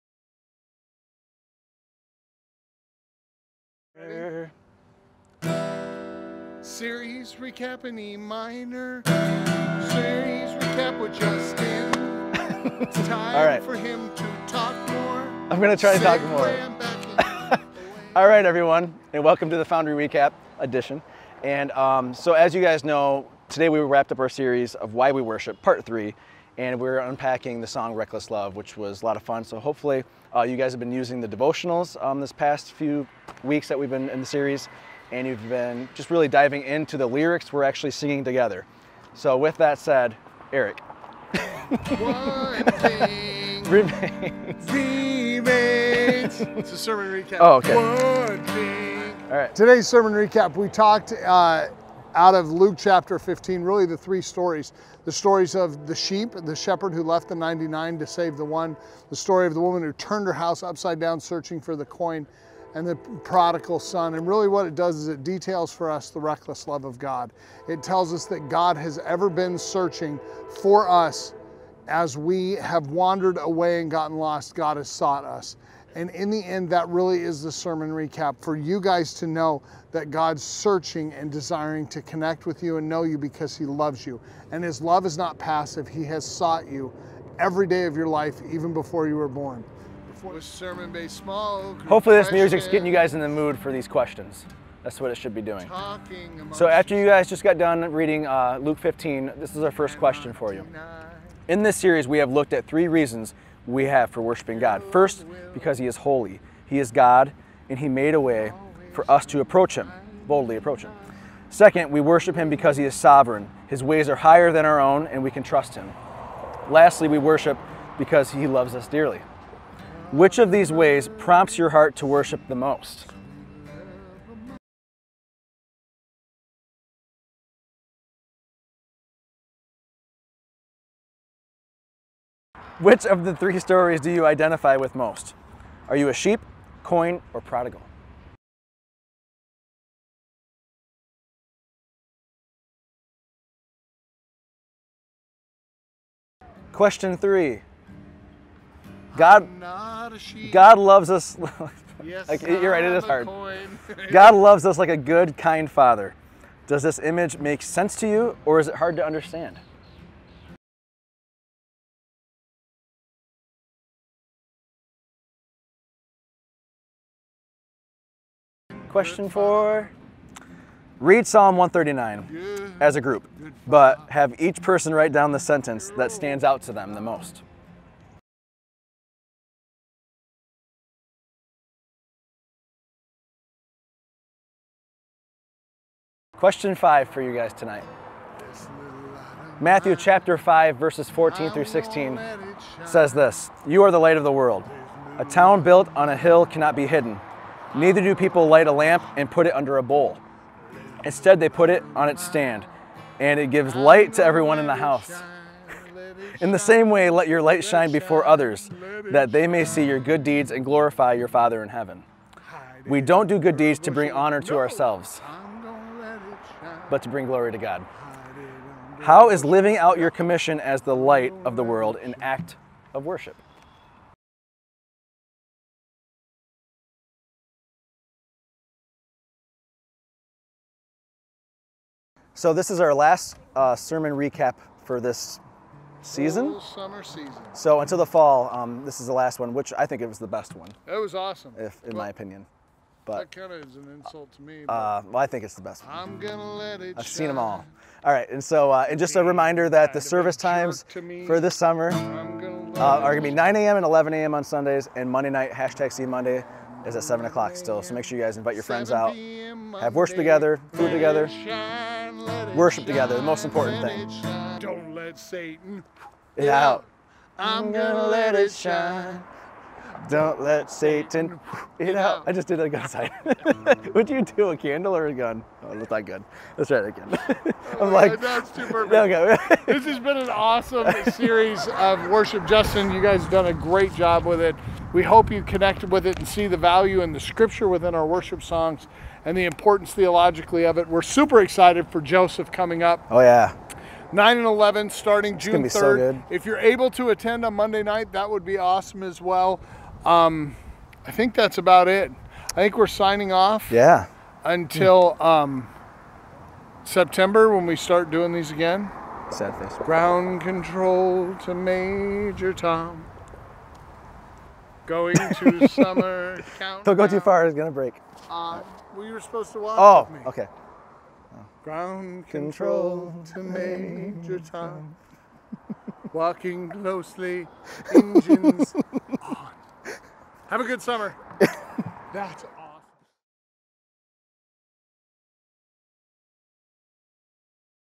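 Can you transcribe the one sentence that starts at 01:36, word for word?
So after you guys just got done reading uh, Luke 15, this is our first question for you.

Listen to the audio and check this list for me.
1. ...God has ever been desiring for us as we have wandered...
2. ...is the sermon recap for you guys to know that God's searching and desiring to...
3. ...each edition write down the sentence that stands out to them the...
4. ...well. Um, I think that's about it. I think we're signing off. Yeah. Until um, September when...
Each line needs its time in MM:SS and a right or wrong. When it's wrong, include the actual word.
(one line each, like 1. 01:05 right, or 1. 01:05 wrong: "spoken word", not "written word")
1. 01:08 wrong: "searching", not "desiring"
2. 01:17 right
3. 02:54 wrong: "person", not "edition"
4. 04:59 right.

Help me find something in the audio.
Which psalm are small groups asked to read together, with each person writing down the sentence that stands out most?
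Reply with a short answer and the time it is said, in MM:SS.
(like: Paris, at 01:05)
Psalm 139, at 02:51.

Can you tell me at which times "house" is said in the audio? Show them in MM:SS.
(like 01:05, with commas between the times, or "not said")
01:00, 03:24.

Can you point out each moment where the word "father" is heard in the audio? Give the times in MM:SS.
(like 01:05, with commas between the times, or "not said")
02:35, 03:31.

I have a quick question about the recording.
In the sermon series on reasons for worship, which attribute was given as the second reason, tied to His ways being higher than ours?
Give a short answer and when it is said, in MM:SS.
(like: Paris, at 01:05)
sovereign, at 01:52.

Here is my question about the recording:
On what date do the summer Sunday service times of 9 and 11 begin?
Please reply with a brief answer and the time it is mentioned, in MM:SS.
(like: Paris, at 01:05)
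June 3rd, at 04:55.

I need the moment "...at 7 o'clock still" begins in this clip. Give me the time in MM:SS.
04:16.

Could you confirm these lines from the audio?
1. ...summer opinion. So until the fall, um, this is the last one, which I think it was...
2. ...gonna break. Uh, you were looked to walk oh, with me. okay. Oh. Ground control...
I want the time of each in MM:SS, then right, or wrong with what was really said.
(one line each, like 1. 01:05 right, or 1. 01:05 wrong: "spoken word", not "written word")
1. 03:56 wrong: "season", not "opinion"
2. 05:17 wrong: "supposed", not "looked".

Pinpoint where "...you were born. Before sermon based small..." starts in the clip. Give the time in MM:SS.
01:29.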